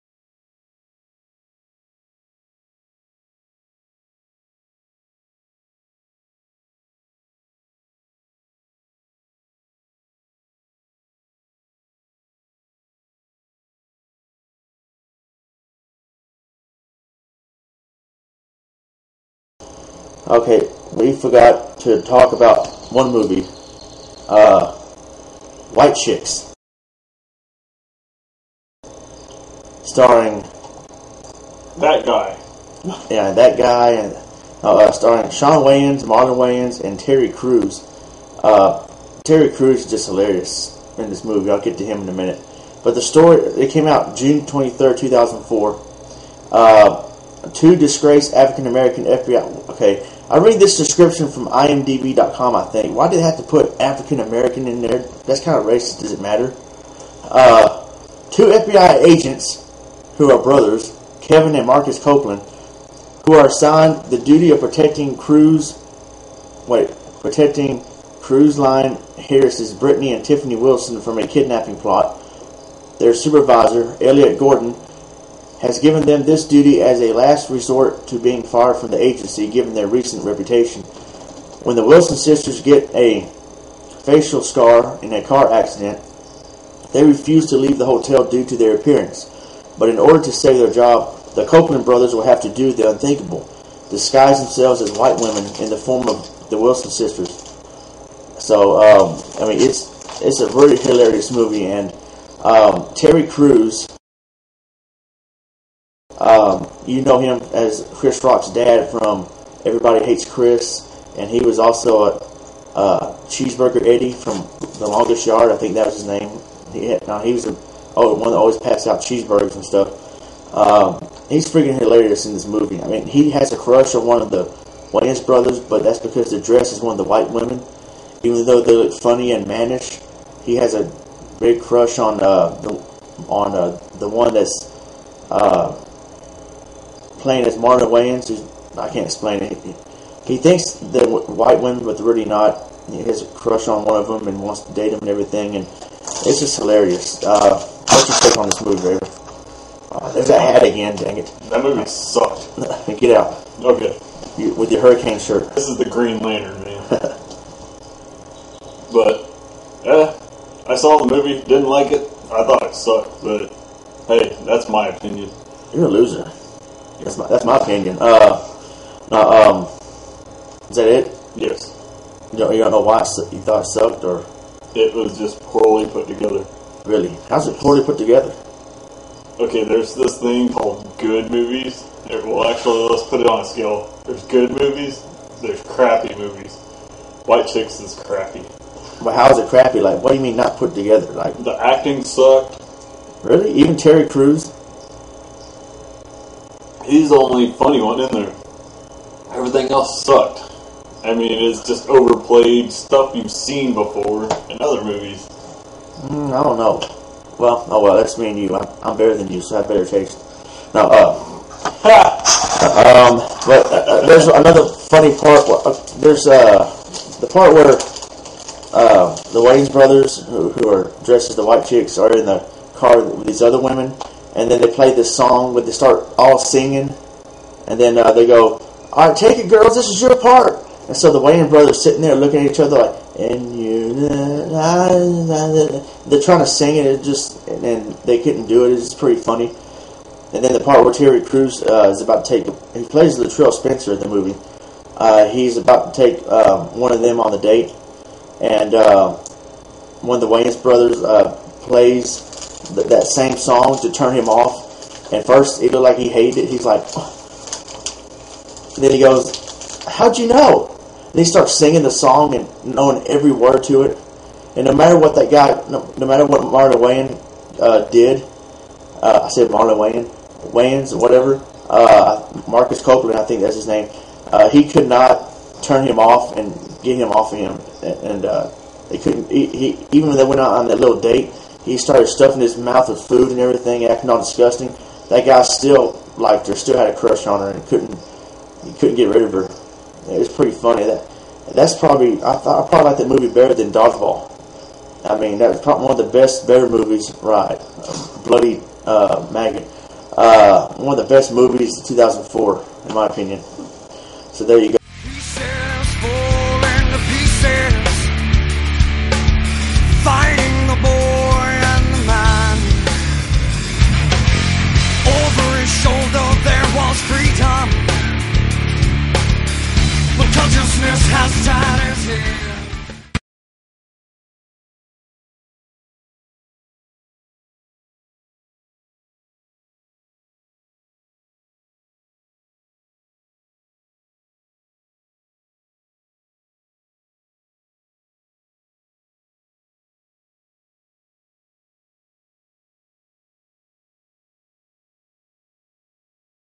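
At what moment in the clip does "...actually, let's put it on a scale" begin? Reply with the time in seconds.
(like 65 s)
182 s.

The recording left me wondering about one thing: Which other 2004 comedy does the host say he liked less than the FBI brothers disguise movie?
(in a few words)
Dodgeball.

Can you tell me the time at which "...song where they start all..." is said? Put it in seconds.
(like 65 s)
225 s.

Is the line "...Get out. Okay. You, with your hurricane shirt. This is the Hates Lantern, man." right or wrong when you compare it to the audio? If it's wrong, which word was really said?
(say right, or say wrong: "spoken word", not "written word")
wrong: "Green", not "Hates".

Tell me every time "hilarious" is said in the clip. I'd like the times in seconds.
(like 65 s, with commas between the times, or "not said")
40 s, 100 s, 121 s, 146 s.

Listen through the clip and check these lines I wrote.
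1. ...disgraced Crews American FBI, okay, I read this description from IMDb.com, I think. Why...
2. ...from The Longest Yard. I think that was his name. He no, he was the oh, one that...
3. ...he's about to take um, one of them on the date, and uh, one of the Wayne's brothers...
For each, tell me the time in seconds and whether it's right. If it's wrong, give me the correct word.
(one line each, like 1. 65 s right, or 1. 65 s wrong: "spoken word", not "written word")
1. 47 s wrong: "African", not "Crews"
2. 114 s right
3. 245 s right.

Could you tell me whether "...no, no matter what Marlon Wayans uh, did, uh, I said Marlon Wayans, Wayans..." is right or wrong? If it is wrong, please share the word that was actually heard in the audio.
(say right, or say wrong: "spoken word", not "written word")
right.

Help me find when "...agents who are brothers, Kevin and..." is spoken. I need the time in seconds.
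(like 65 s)
59 s.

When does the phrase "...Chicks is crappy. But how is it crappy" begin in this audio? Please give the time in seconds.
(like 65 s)
187 s.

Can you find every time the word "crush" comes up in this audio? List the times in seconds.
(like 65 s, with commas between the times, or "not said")
123 s, 131 s, 143 s, 286 s.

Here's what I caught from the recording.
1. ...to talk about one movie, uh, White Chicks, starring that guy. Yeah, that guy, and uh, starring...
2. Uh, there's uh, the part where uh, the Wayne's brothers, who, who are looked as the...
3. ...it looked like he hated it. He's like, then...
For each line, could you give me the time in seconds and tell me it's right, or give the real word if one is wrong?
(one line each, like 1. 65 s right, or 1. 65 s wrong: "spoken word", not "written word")
1. 21 s right
2. 215 s wrong: "dressed", not "looked"
3. 255 s right.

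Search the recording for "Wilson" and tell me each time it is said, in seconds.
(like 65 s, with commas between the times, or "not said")
70 s, 81 s, 96 s.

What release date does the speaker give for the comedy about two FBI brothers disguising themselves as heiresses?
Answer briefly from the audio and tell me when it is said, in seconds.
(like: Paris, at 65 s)
June 23rd, 2004, at 44 s.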